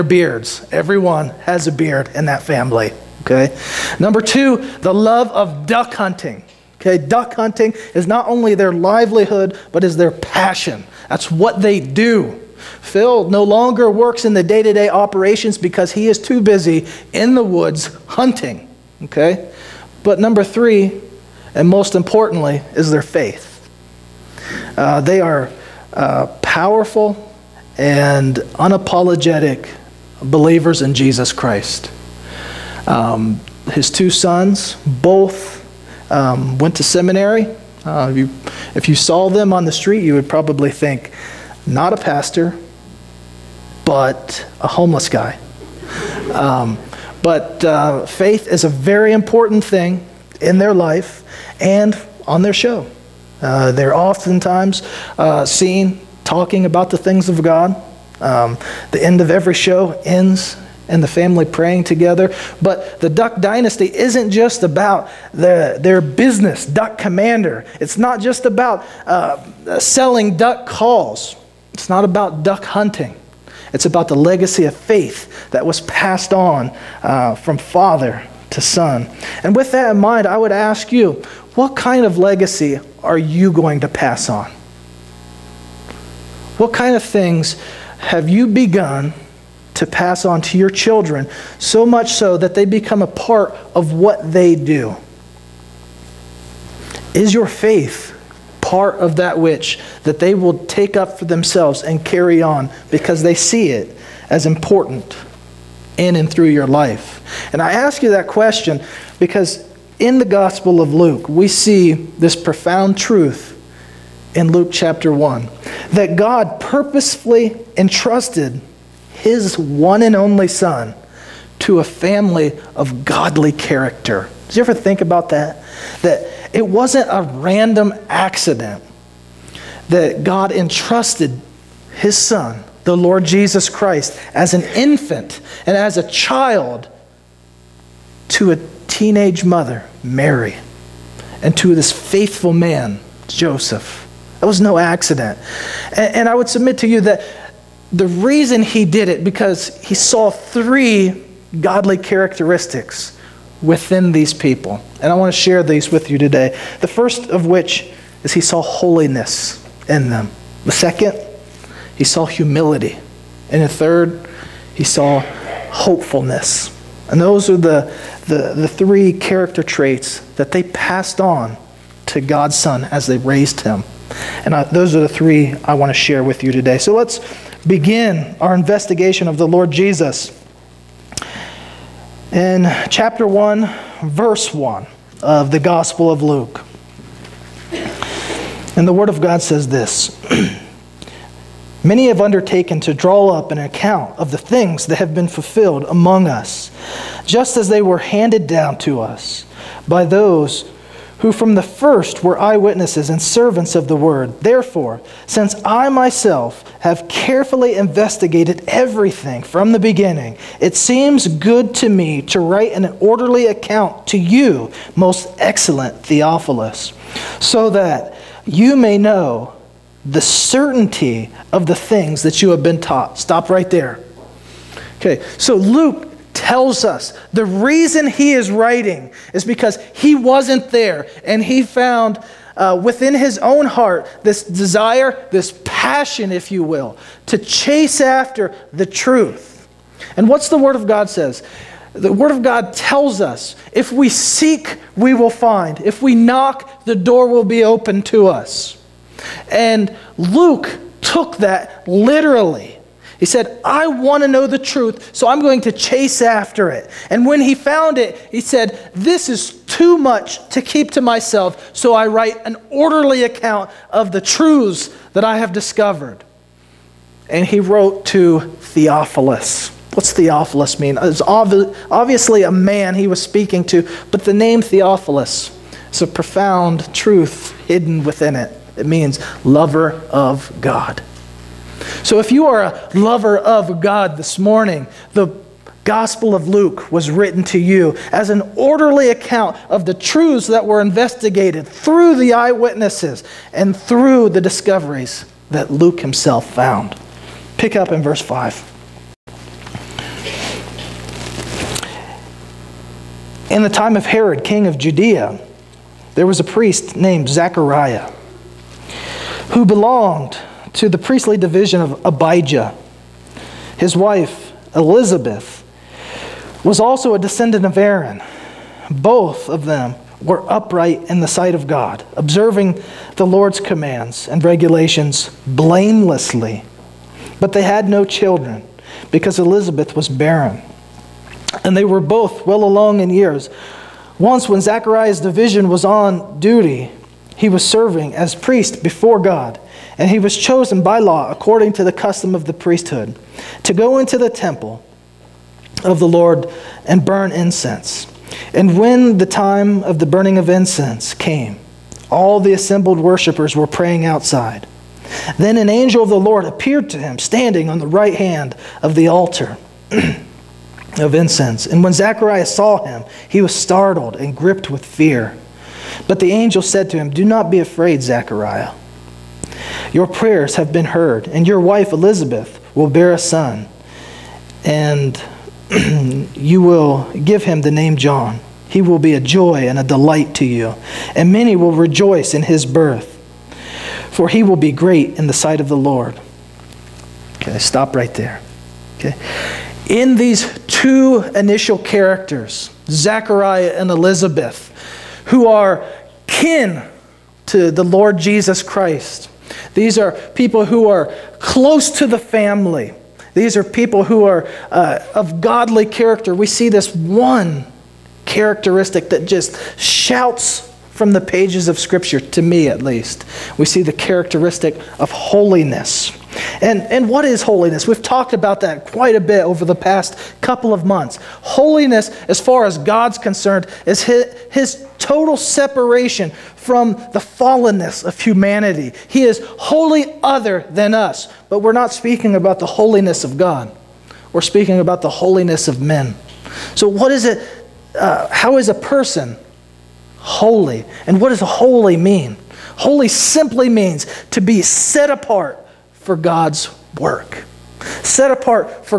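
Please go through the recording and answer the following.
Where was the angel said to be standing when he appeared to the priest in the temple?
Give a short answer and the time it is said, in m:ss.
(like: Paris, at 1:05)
right hand of the altar, at 5:57.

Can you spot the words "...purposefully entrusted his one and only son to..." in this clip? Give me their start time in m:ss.
1:56.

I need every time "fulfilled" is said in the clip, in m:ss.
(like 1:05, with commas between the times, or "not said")
3:15.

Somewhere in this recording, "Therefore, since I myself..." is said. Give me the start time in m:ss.
3:24.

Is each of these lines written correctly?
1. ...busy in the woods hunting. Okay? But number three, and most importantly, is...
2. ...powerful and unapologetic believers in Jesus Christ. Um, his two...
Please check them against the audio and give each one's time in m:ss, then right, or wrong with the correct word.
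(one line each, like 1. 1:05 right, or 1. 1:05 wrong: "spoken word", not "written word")
1. 0:16 right
2. 0:26 right.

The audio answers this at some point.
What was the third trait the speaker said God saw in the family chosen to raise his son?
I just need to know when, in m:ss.
2:45.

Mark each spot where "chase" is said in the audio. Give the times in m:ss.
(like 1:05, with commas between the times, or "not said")
3:57, 4:15.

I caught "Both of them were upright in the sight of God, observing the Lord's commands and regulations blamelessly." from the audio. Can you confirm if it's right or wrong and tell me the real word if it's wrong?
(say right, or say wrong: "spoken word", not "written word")
right.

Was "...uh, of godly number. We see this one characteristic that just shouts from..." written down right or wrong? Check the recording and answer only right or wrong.
wrong.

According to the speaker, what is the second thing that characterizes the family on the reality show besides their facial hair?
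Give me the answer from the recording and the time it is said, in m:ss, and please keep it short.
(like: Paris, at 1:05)
love of duck hunting, at 0:04.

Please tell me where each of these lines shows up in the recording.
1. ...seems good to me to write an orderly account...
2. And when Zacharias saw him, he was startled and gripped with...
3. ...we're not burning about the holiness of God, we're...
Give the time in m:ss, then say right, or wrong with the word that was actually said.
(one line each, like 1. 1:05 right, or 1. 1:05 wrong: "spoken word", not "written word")
1. 3:30 right
2. 6:01 right
3. 7:11 wrong: "speaking", not "burning".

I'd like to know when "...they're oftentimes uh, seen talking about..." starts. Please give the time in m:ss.
0:53.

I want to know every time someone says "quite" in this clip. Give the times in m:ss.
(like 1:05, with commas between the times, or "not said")
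6:58.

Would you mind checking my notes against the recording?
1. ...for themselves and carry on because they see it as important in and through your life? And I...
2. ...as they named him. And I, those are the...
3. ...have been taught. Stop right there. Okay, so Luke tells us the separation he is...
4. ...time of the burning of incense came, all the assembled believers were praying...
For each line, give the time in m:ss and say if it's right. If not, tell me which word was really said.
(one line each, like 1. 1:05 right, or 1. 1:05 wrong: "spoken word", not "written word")
1. 1:41 right
2. 2:52 wrong: "raised", not "named"
3. 3:42 wrong: "reason", not "separation"
4. 5:49 wrong: "worshippers", not "believers".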